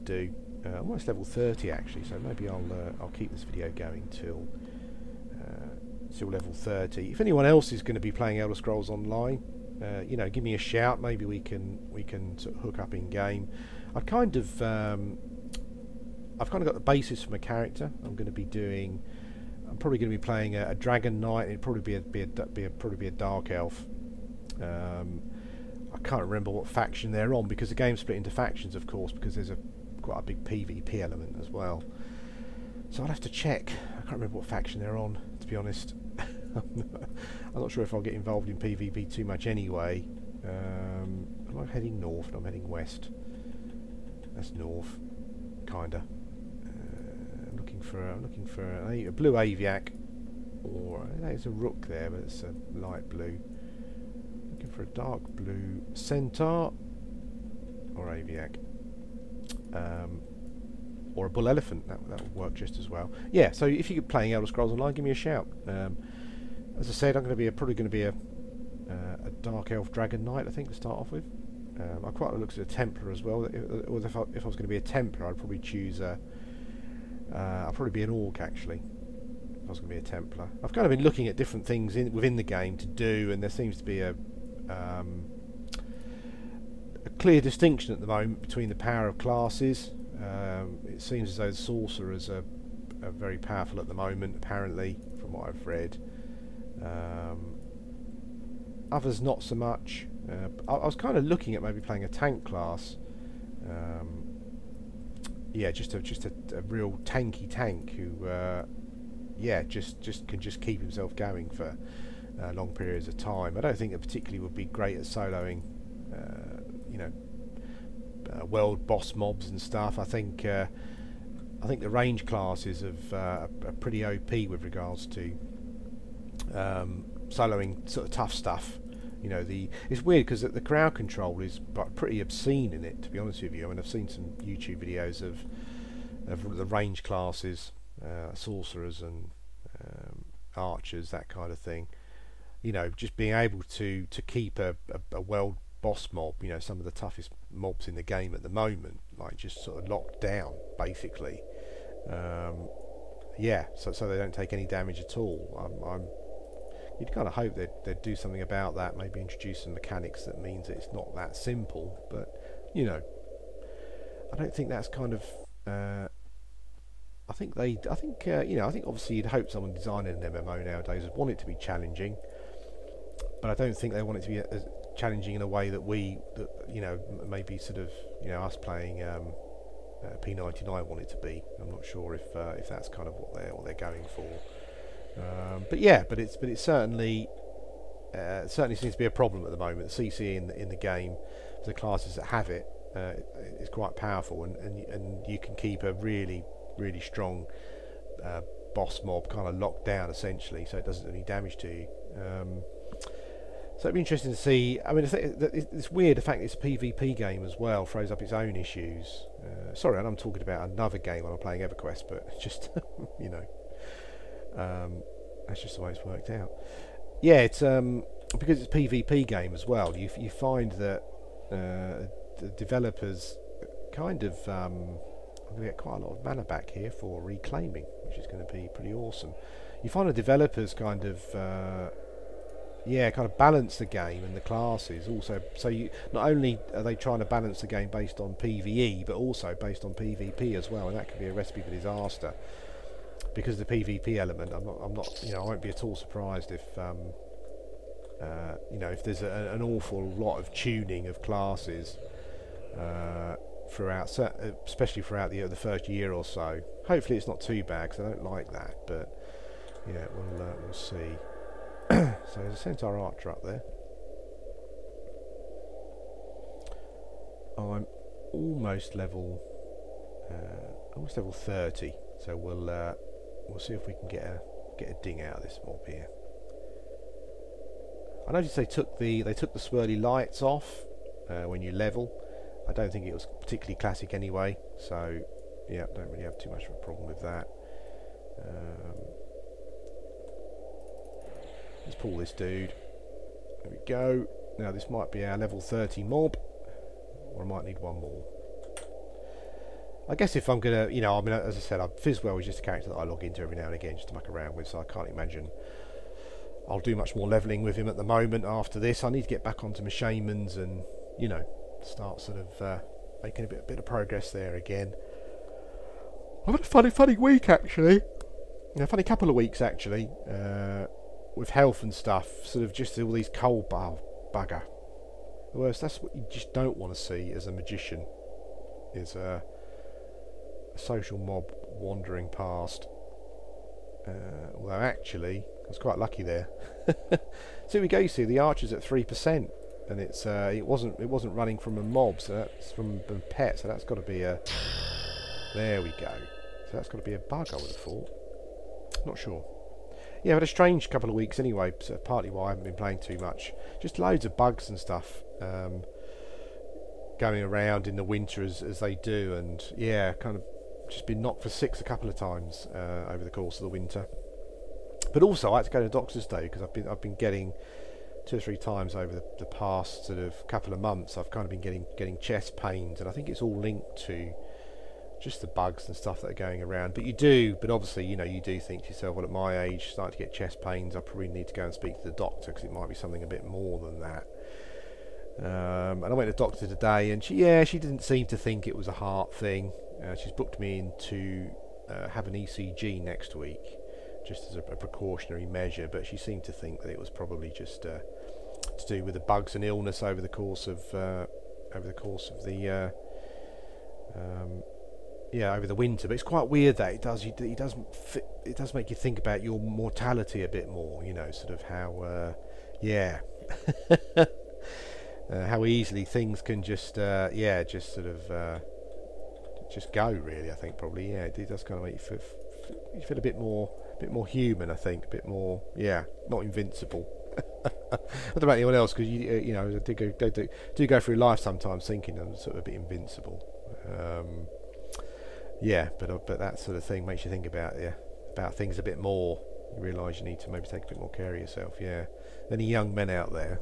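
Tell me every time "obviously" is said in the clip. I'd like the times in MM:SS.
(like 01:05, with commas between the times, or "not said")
02:48, 06:17.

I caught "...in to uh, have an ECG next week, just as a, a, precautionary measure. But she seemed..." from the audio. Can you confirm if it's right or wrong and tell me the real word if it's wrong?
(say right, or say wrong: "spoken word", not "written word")
right.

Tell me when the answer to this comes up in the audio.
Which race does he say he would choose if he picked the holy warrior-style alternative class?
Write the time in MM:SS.
01:18.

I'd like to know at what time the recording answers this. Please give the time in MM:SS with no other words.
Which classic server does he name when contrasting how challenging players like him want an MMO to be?
03:00.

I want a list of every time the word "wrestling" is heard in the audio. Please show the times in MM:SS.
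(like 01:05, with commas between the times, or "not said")
not said.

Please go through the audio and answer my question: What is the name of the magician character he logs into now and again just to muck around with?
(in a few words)
Fizzwell.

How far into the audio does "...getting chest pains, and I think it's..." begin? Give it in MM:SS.
06:11.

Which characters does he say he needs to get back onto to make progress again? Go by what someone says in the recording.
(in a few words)
Shamans.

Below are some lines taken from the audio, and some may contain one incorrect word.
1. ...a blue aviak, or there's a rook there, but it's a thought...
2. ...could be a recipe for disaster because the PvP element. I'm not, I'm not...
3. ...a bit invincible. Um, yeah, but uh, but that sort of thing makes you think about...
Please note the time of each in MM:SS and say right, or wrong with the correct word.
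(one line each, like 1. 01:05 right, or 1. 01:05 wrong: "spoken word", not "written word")
1. 00:49 wrong: "light", not "thought"
2. 04:01 right
3. 07:12 right.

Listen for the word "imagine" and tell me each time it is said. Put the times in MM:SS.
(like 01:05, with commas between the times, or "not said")
05:05.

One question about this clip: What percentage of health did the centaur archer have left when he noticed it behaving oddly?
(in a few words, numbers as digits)
3%.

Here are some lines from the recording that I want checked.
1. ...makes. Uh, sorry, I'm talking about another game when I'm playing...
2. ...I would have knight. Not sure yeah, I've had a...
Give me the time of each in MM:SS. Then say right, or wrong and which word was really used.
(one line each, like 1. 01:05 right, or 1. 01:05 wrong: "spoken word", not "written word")
1. 03:28 wrong: "issues", not "makes"
2. 05:47 wrong: "thought", not "knight".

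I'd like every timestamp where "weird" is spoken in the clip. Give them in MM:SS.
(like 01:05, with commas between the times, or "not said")
02:10, 03:25, 06:46.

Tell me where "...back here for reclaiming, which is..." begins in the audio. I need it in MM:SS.
03:46.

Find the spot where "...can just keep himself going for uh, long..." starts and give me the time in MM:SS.
01:50.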